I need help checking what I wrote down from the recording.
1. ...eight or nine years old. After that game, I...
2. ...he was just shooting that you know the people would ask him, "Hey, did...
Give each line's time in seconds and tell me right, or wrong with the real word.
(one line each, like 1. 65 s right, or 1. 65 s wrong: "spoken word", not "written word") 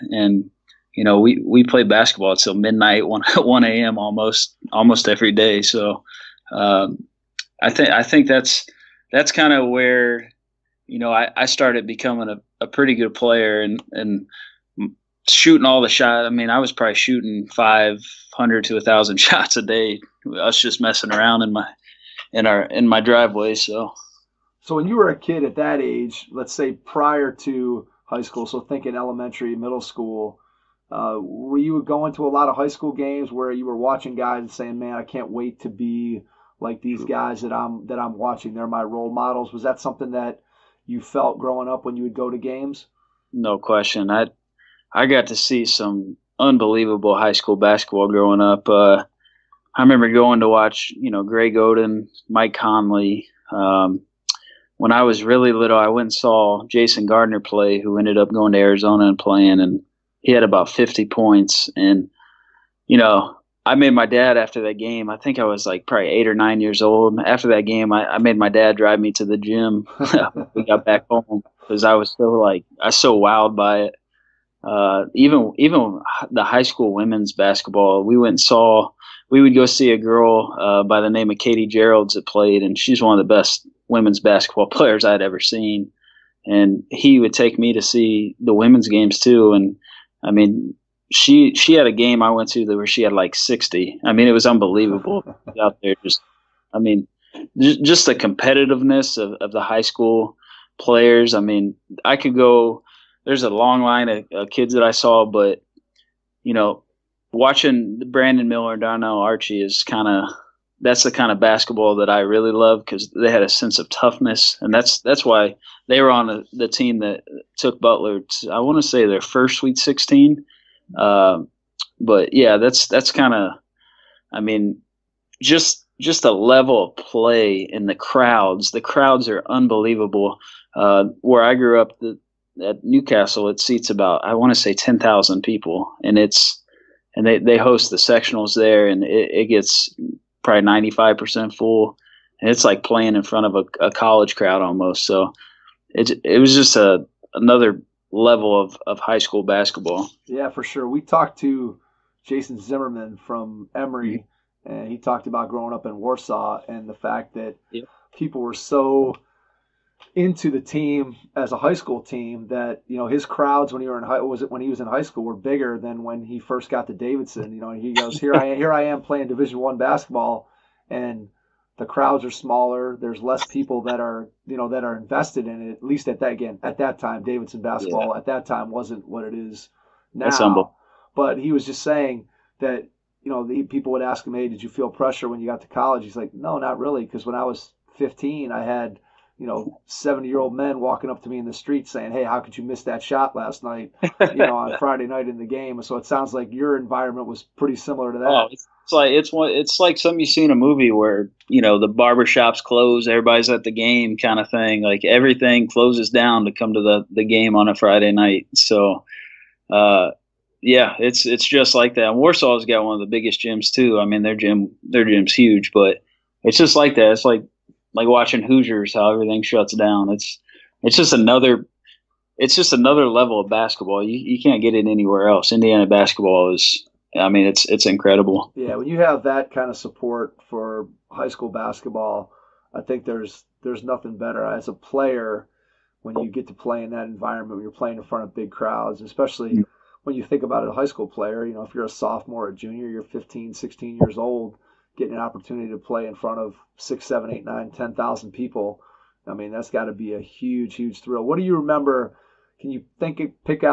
1. 66 s right
2. 181 s wrong: "saying", not "shooting".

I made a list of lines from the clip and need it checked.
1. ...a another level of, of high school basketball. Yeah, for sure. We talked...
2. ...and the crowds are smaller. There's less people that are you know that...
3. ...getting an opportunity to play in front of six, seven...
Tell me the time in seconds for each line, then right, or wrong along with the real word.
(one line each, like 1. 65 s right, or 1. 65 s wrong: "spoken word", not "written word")
1. 146 s right
2. 170 s right
3. 244 s right.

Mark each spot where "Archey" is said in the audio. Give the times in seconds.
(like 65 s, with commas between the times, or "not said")
109 s.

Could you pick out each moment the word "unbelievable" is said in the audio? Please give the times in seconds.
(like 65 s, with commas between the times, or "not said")
46 s, 94 s, 129 s.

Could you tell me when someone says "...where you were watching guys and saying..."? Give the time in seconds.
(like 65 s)
33 s.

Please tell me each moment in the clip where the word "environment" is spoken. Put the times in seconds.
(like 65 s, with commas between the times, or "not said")
196 s, 237 s.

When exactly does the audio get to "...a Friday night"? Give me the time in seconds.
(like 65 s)
207 s.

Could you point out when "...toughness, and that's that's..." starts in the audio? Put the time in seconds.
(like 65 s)
113 s.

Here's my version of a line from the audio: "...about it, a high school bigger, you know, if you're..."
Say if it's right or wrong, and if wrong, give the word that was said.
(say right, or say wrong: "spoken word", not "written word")
wrong: "player", not "bigger".